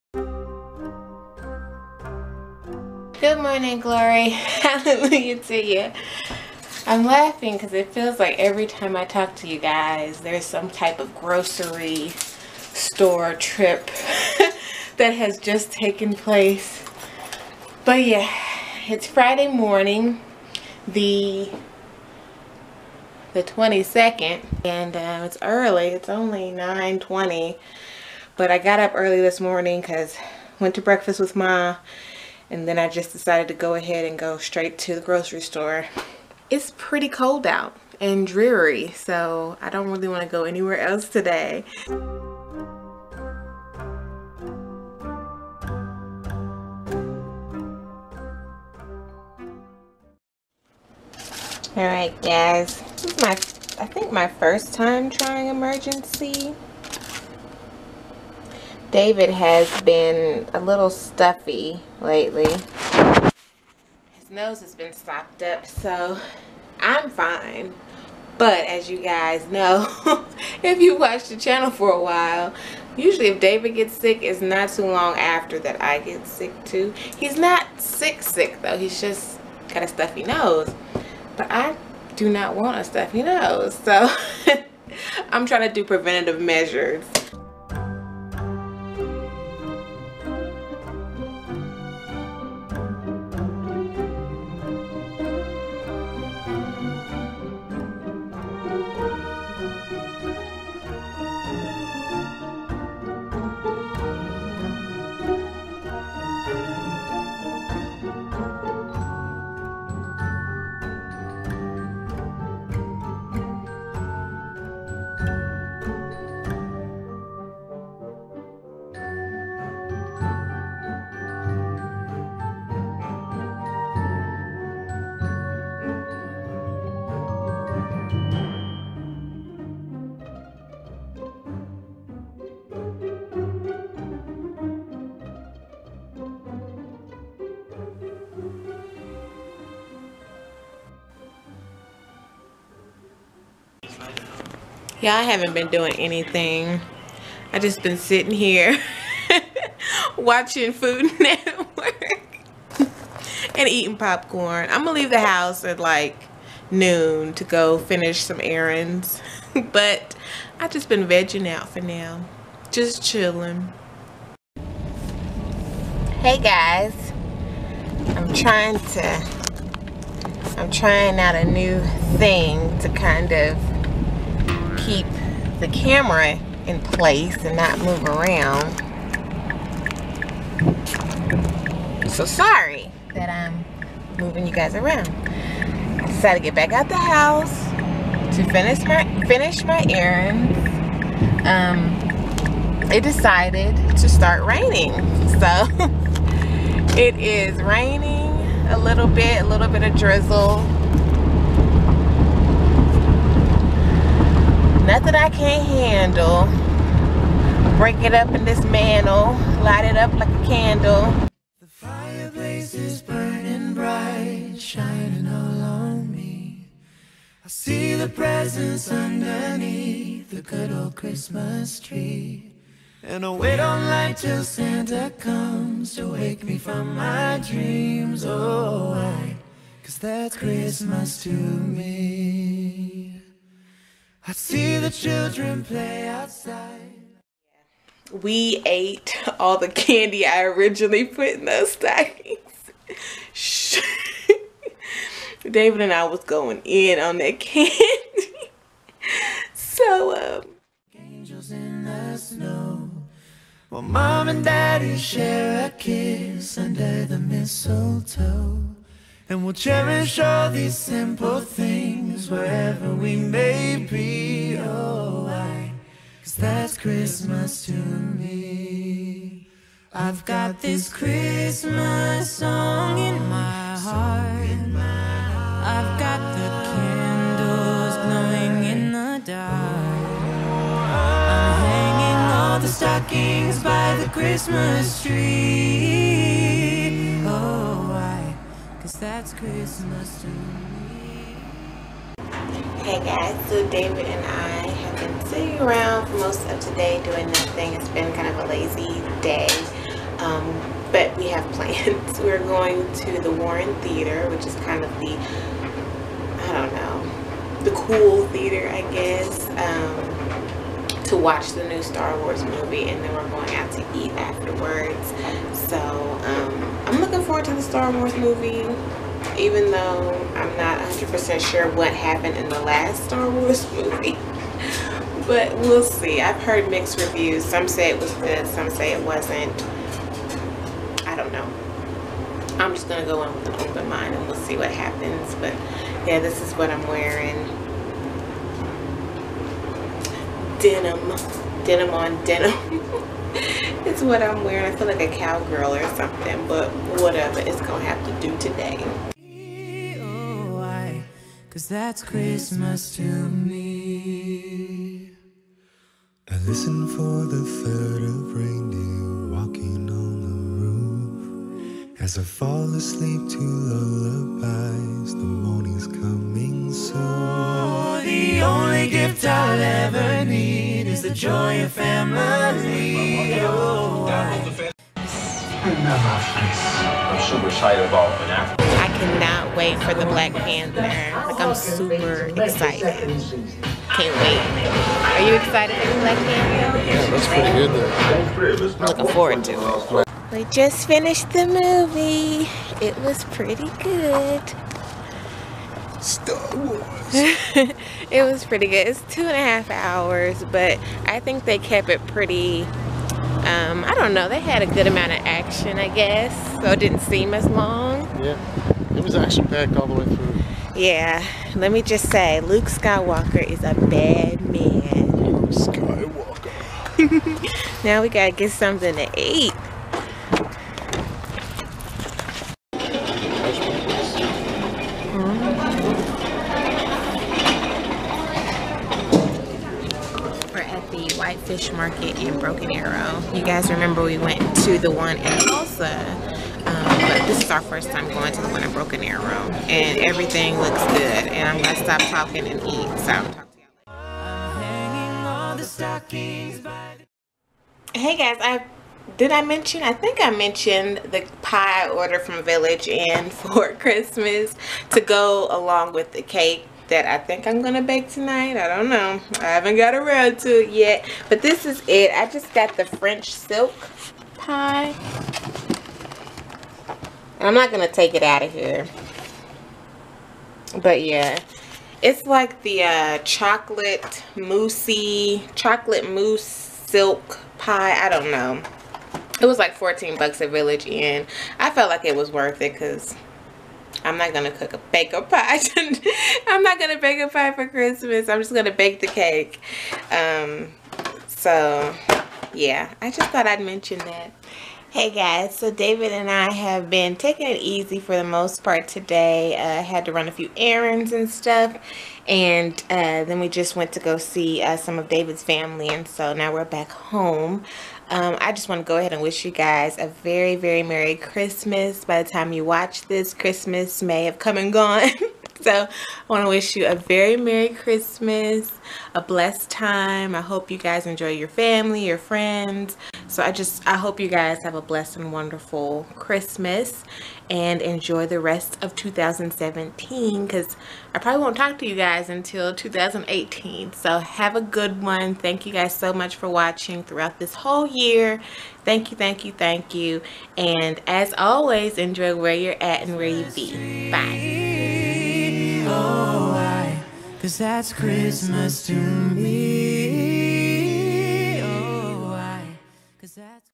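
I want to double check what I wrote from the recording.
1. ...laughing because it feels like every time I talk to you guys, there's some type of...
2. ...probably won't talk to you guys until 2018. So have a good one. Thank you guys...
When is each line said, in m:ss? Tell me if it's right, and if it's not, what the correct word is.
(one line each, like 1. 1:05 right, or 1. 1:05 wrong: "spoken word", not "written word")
1. 0:07 right
2. 8:51 right.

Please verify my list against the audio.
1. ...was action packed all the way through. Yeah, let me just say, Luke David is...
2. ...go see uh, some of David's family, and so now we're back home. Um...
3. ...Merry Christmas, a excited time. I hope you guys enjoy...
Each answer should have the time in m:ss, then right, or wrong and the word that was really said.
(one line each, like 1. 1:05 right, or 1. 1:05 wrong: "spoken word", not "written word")
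1. 6:49 wrong: "Skywalker", not "David"
2. 8:24 right
3. 8:37 wrong: "blessed", not "excited".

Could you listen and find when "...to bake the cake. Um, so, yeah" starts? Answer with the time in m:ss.
8:08.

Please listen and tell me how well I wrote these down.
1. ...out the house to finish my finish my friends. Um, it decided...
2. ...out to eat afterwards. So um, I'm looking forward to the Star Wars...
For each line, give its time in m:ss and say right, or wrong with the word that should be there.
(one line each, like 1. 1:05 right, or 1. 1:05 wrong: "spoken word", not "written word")
1. 3:06 wrong: "errands", not "friends"
2. 5:13 right.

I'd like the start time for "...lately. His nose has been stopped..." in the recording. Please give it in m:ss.
1:02.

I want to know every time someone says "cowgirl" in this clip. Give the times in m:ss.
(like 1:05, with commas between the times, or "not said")
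5:45.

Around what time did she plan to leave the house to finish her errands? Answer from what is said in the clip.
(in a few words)
noon.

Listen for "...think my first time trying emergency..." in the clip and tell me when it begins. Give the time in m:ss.
0:53.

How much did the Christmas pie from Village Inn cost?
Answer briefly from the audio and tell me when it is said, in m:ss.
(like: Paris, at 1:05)
$14, at 7:59.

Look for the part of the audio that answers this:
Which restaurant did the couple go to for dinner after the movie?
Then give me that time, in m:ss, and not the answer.
7:11.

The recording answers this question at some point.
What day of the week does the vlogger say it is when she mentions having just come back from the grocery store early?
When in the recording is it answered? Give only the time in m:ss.
0:19.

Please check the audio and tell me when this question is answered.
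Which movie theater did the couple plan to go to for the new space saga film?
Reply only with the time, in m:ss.
5:03.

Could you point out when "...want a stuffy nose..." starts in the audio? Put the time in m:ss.
1:22.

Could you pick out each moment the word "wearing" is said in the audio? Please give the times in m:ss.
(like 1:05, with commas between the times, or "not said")
5:36, 5:44.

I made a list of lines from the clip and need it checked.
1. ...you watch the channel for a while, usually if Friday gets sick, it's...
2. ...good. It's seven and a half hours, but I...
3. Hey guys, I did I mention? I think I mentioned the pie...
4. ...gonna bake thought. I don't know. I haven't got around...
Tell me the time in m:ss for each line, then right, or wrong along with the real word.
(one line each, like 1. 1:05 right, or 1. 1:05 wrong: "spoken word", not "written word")
1. 1:10 wrong: "David", not "Friday"
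2. 6:38 wrong: "two", not "seven"
3. 7:27 right
4. 7:37 wrong: "tonight", not "thought".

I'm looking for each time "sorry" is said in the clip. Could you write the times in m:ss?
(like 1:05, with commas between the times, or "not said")
3:02.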